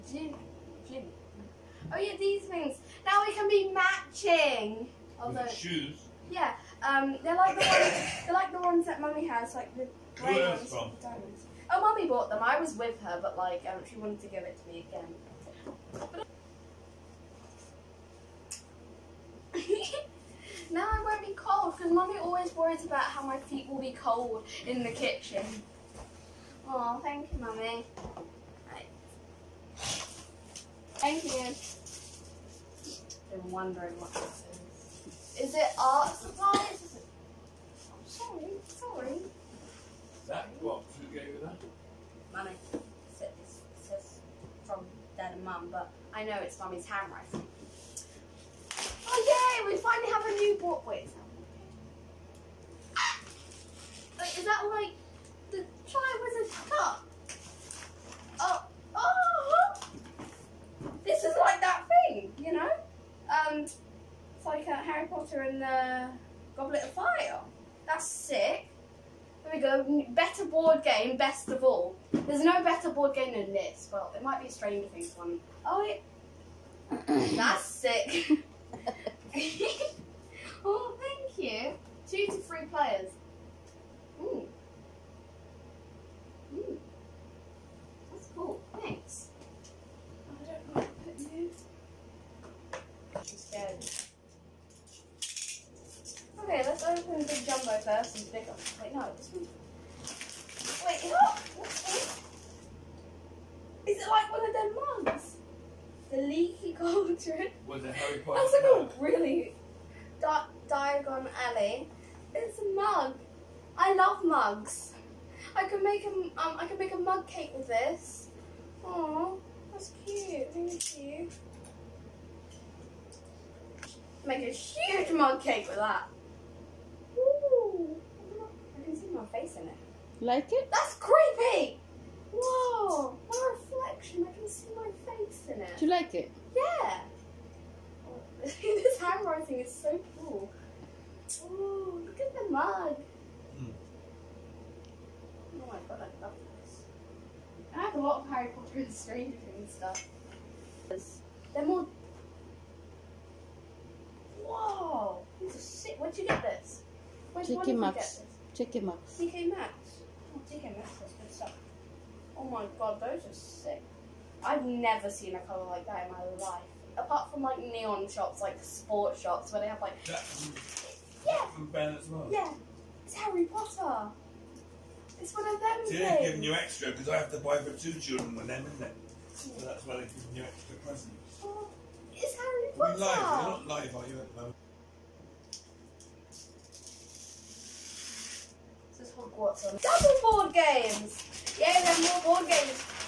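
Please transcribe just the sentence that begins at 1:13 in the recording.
Well, it might be a Stranger Things one.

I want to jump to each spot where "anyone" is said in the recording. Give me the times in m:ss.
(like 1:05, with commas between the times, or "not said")
not said.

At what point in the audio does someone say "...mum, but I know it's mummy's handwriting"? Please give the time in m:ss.
0:45.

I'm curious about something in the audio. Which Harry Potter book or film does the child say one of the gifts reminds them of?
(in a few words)
Goblet of Fire.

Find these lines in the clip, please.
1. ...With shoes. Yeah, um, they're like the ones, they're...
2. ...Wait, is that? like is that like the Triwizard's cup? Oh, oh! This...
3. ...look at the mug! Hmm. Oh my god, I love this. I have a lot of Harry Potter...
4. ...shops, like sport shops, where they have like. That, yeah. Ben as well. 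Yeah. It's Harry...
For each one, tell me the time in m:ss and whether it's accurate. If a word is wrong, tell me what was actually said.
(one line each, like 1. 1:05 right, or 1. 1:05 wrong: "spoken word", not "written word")
1. 0:05 right
2. 0:50 right
3. 2:22 right
4. 2:48 right.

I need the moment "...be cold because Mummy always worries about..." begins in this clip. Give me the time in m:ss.
0:21.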